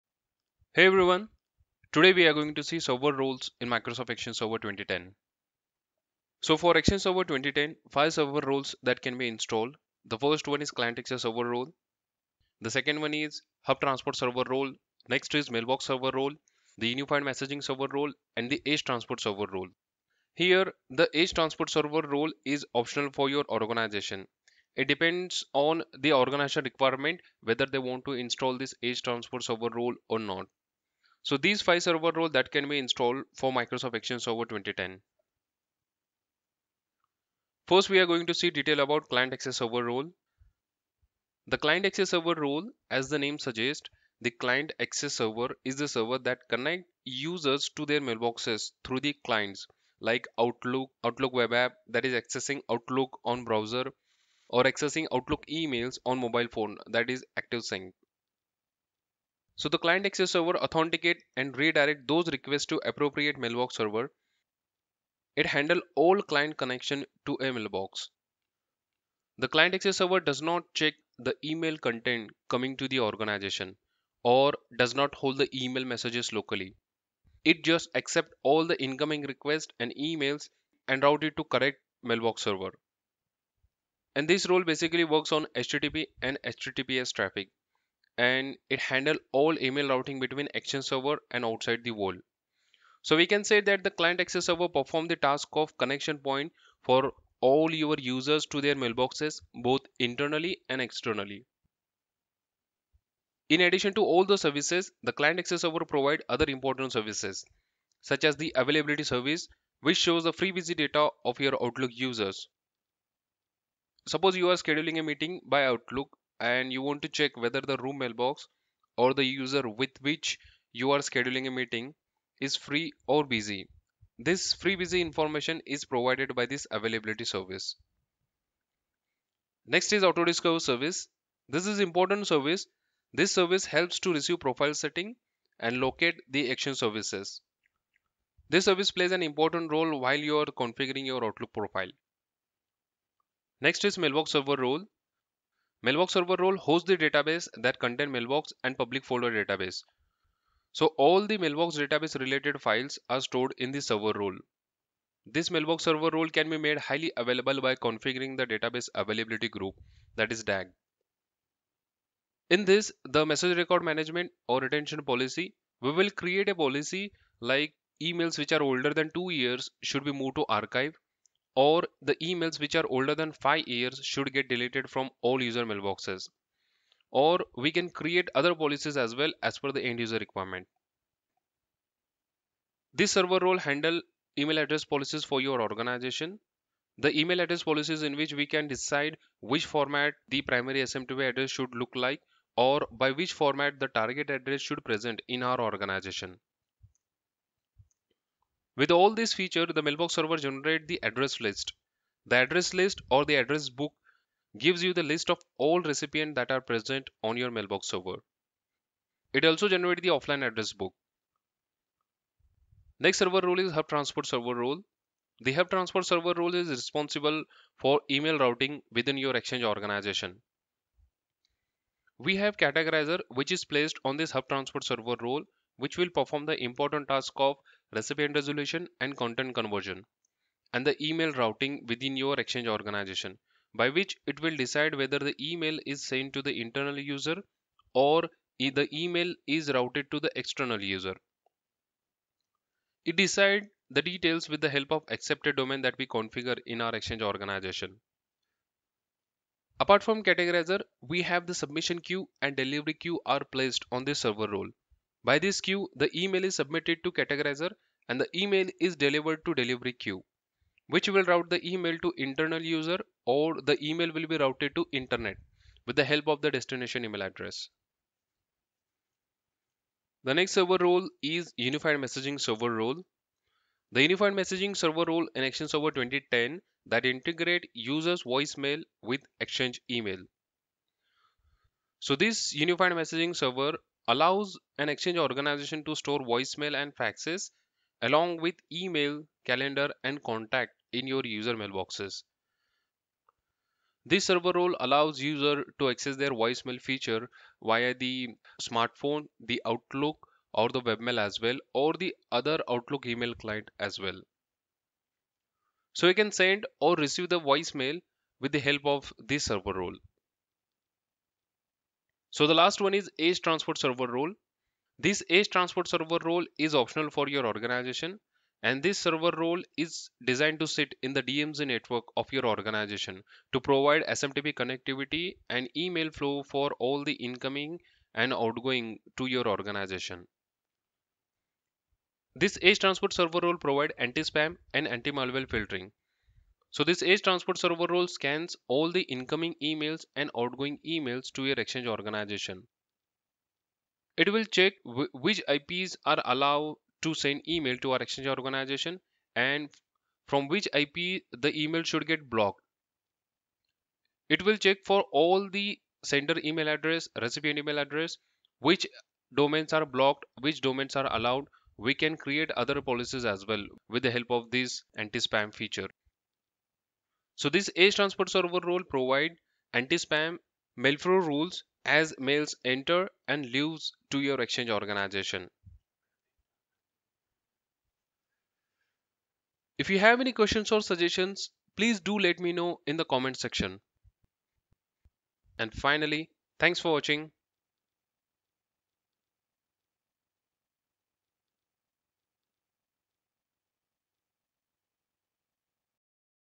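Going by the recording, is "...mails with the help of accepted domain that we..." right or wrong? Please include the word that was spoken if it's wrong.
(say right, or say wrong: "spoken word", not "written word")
wrong: "details", not "mails".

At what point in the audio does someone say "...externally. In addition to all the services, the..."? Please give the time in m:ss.
1:40.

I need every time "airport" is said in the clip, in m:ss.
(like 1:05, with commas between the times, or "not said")
not said.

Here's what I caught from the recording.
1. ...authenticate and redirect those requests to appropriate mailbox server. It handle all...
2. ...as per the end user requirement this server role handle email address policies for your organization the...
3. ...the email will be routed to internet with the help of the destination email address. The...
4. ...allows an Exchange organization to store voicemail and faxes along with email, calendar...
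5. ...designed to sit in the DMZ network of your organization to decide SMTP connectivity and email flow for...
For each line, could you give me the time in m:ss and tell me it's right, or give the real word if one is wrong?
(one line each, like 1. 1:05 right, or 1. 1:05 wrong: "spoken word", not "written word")
1. 1:00 right
2. 2:59 right
3. 4:23 right
4. 4:44 right
5. 5:20 wrong: "provide", not "decide".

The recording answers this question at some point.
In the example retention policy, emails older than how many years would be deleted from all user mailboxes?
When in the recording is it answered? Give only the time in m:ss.
2:53.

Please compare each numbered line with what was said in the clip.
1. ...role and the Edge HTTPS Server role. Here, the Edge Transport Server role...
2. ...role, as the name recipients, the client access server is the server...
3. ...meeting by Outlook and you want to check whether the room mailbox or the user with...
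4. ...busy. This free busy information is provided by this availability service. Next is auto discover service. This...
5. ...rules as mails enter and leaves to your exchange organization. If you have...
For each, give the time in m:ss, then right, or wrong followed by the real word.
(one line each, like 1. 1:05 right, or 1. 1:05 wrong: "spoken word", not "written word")
1. 0:17 wrong: "Transport", not "HTTPS"
2. 0:42 wrong: "suggests", not "recipients"
3. 1:55 right
4. 2:03 right
5. 6:11 right.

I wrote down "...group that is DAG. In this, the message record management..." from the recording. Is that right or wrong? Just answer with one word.
right.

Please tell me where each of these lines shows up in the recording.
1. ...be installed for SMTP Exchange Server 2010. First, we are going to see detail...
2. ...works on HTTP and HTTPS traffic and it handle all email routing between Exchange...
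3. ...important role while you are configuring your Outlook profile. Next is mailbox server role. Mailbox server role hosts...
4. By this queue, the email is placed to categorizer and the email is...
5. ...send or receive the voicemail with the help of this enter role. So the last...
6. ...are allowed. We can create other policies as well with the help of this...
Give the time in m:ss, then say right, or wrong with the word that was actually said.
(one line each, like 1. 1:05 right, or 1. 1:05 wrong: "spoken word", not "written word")
1. 0:32 wrong: "Microsoft", not "SMTP"
2. 1:25 right
3. 2:19 right
4. 4:15 wrong: "submitted", not "placed"
5. 5:06 wrong: "server", not "enter"
6. 6:00 right.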